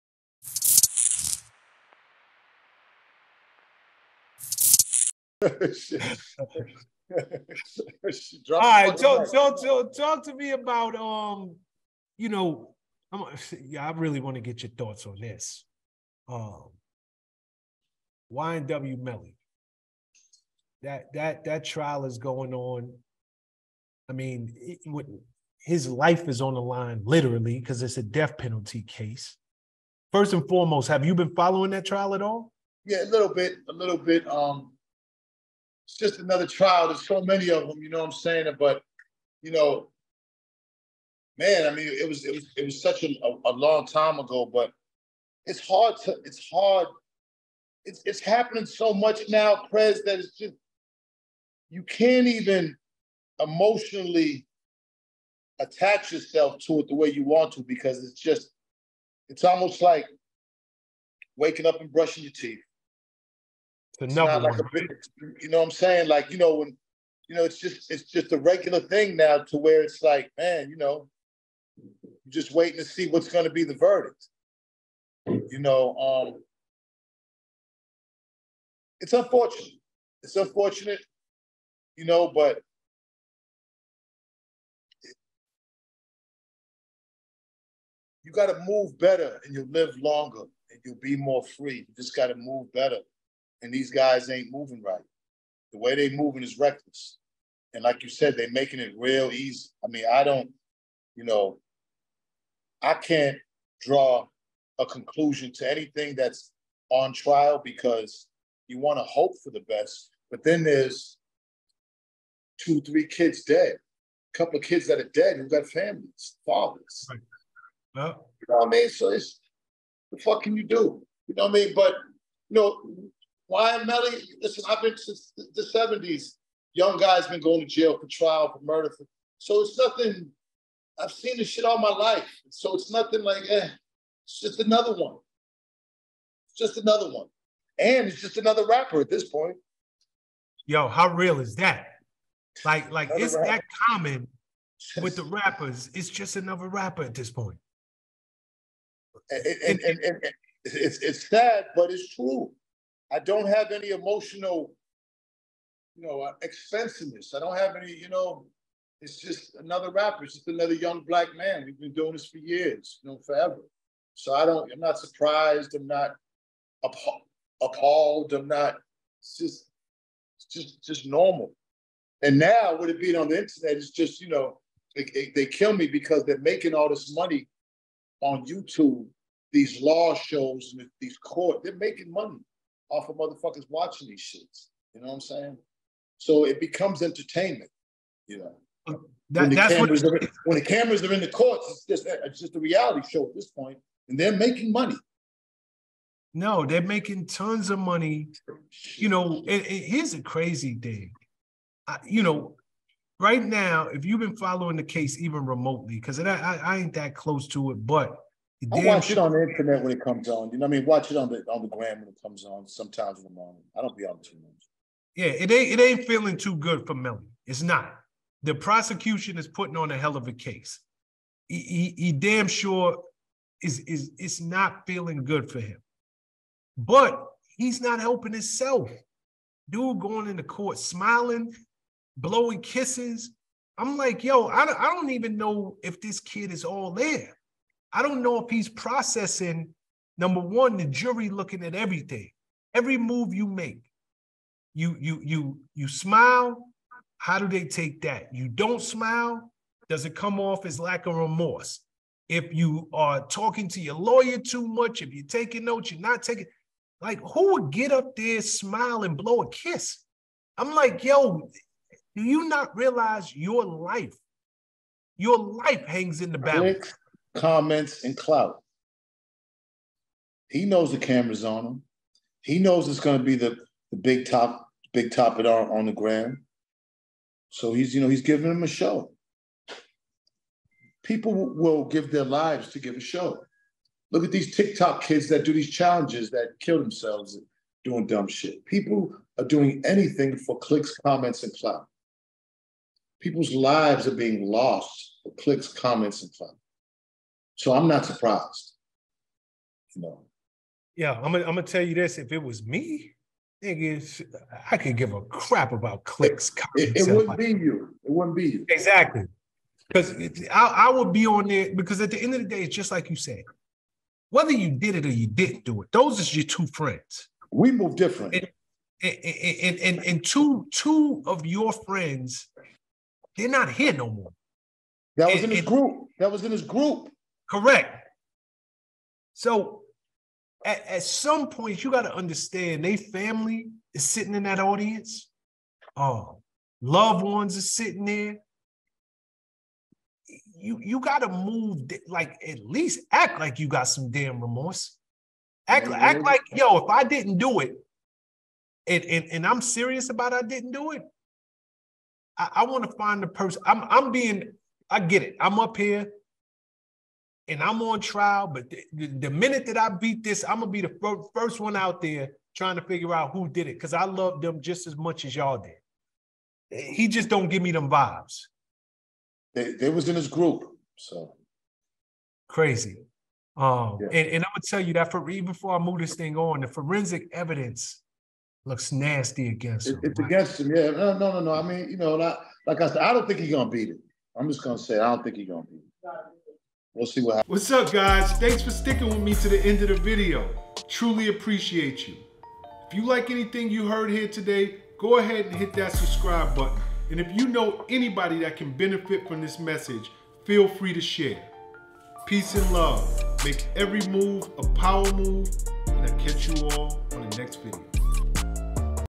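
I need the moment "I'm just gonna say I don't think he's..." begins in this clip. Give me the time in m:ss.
6:24.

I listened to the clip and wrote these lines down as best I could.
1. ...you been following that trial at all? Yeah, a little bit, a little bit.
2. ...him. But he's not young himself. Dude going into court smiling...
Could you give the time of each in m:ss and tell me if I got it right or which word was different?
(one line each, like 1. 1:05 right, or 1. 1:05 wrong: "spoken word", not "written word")
1. 0:31 right
2. 3:45 wrong: "helping", not "young".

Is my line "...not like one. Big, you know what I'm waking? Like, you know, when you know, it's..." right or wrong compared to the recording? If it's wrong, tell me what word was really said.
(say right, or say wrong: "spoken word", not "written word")
wrong: "saying", not "waking".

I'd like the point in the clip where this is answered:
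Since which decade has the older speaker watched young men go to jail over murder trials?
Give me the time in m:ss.
2:05.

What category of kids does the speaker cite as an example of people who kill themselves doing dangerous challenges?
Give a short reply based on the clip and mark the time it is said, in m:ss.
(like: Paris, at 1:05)
TikTok kids, at 4:44.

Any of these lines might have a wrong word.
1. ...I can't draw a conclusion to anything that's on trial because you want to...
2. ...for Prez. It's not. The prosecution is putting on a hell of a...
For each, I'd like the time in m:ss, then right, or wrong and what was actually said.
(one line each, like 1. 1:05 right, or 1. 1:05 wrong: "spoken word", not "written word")
1. 1:42 right
2. 3:36 wrong: "Melly", not "Prez".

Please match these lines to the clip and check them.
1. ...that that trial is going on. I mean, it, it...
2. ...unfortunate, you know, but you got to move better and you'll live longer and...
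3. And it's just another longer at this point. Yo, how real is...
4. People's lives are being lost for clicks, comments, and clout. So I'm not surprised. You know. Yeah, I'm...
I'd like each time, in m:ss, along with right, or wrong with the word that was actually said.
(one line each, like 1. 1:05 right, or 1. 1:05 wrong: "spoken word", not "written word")
1. 0:21 right
2. 1:20 right
3. 2:17 wrong: "rapper", not "longer"
4. 4:53 right.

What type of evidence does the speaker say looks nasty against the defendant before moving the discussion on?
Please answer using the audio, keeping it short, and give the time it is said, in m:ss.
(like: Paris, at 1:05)
forensic evidence, at 6:16.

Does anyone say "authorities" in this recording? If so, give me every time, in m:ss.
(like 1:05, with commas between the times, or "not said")
not said.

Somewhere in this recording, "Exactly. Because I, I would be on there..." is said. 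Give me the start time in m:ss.
5:08.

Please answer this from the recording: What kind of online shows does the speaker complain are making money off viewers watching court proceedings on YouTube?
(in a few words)
law shows.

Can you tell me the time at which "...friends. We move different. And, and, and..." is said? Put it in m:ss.
5:16.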